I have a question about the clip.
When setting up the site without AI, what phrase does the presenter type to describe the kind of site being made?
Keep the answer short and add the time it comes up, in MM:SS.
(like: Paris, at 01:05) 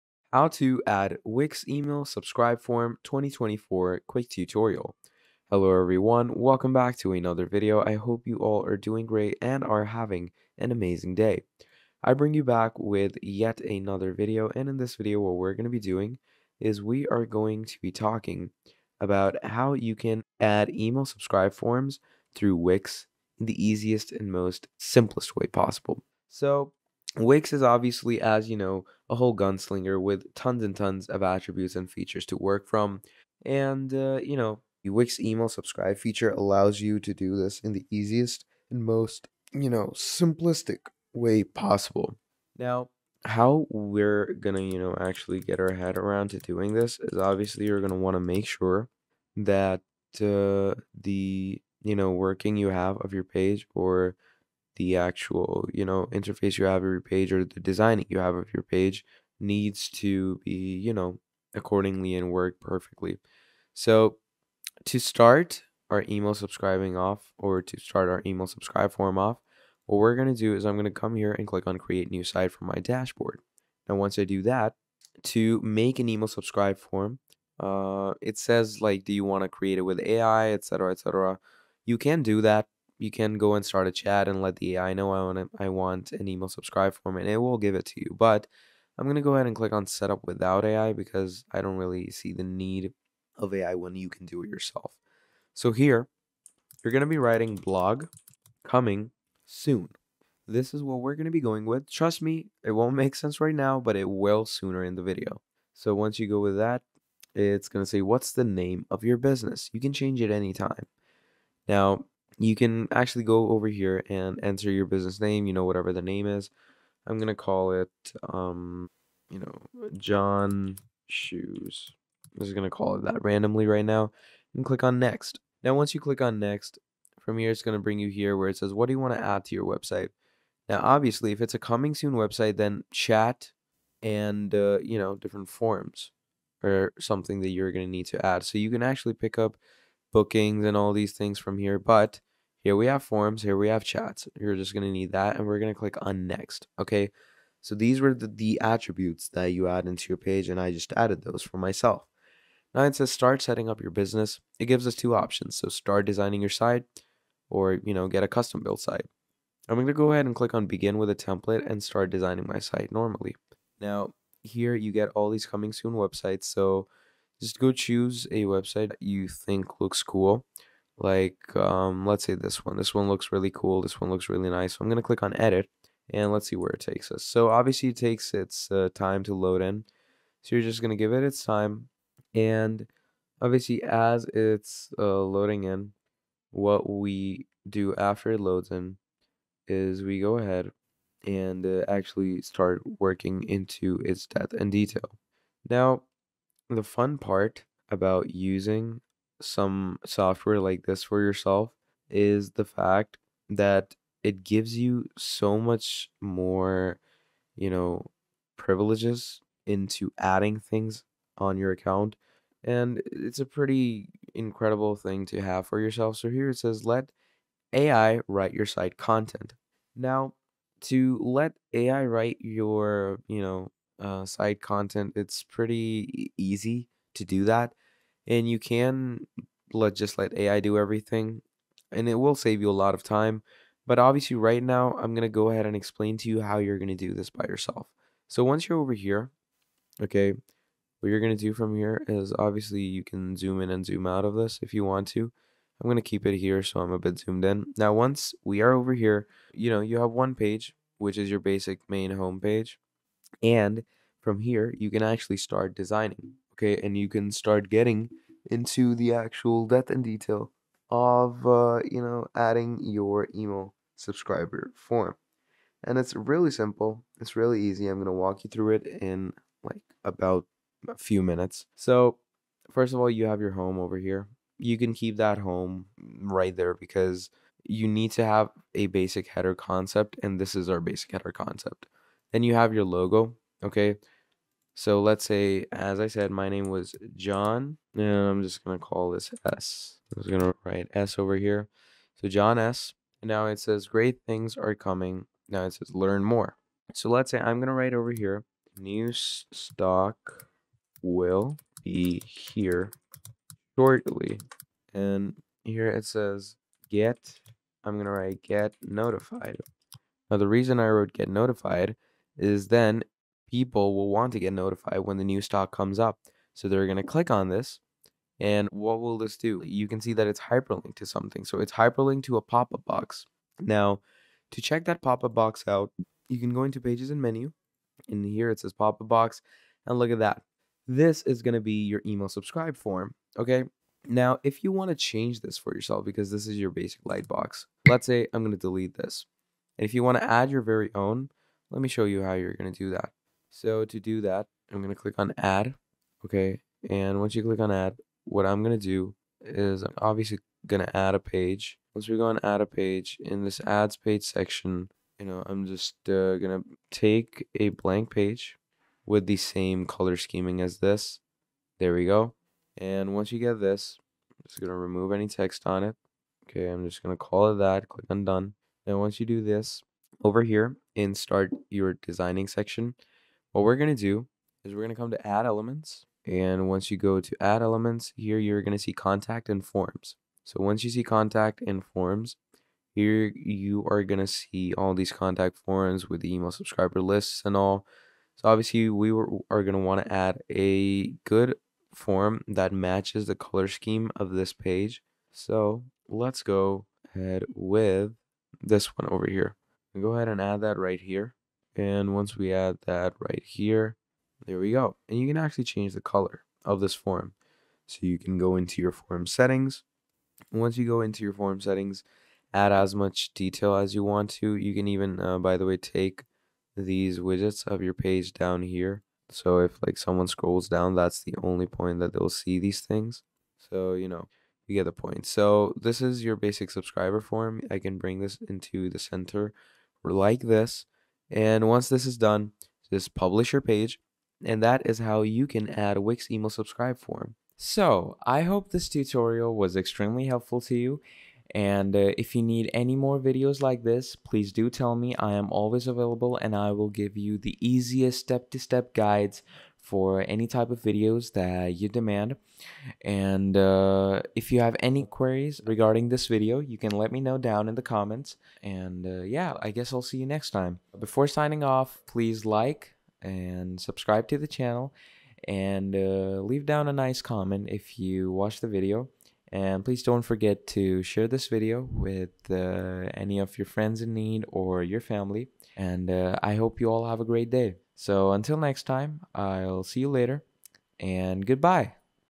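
blog coming soon, at 01:37.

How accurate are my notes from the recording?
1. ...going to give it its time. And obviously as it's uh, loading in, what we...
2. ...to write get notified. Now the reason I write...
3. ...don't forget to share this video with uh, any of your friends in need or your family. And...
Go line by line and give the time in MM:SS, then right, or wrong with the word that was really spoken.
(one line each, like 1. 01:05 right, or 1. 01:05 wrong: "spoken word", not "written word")
1. 03:00 right
2. 05:08 wrong: "wrote", not "write"
3. 07:50 right.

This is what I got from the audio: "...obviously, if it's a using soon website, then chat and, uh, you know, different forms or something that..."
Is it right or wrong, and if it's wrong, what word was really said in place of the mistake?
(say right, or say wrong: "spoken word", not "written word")
wrong: "coming", not "using".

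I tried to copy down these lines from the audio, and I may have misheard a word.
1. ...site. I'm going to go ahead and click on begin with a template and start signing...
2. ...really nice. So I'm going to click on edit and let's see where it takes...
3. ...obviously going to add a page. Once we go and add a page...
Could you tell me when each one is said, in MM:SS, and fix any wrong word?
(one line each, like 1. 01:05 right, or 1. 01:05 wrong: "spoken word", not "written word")
1. 02:38 wrong: "designing", not "signing"
2. 02:54 right
3. 05:49 right.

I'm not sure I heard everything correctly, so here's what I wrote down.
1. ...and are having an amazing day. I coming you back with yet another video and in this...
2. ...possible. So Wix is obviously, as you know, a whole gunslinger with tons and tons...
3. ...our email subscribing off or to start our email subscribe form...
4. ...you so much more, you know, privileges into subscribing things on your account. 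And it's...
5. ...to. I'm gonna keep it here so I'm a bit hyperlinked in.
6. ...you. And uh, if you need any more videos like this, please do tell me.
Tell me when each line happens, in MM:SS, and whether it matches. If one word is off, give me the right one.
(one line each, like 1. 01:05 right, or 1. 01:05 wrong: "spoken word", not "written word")
1. 00:09 wrong: "bring", not "coming"
2. 00:25 right
3. 01:05 right
4. 03:24 wrong: "adding", not "subscribing"
5. 04:05 wrong: "zoomed", not "hyperlinked"
6. 07:20 right.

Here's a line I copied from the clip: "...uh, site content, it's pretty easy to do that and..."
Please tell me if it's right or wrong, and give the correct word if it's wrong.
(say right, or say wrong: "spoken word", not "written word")
right.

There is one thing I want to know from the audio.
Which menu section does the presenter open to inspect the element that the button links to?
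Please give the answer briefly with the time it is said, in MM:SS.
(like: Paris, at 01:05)
Pages and Menu, at 05:26.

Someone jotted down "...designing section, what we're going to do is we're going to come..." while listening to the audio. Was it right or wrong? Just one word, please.
right.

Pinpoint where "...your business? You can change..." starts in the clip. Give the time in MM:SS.
01:49.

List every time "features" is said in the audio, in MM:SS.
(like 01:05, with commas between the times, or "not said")
00:31, 00:35.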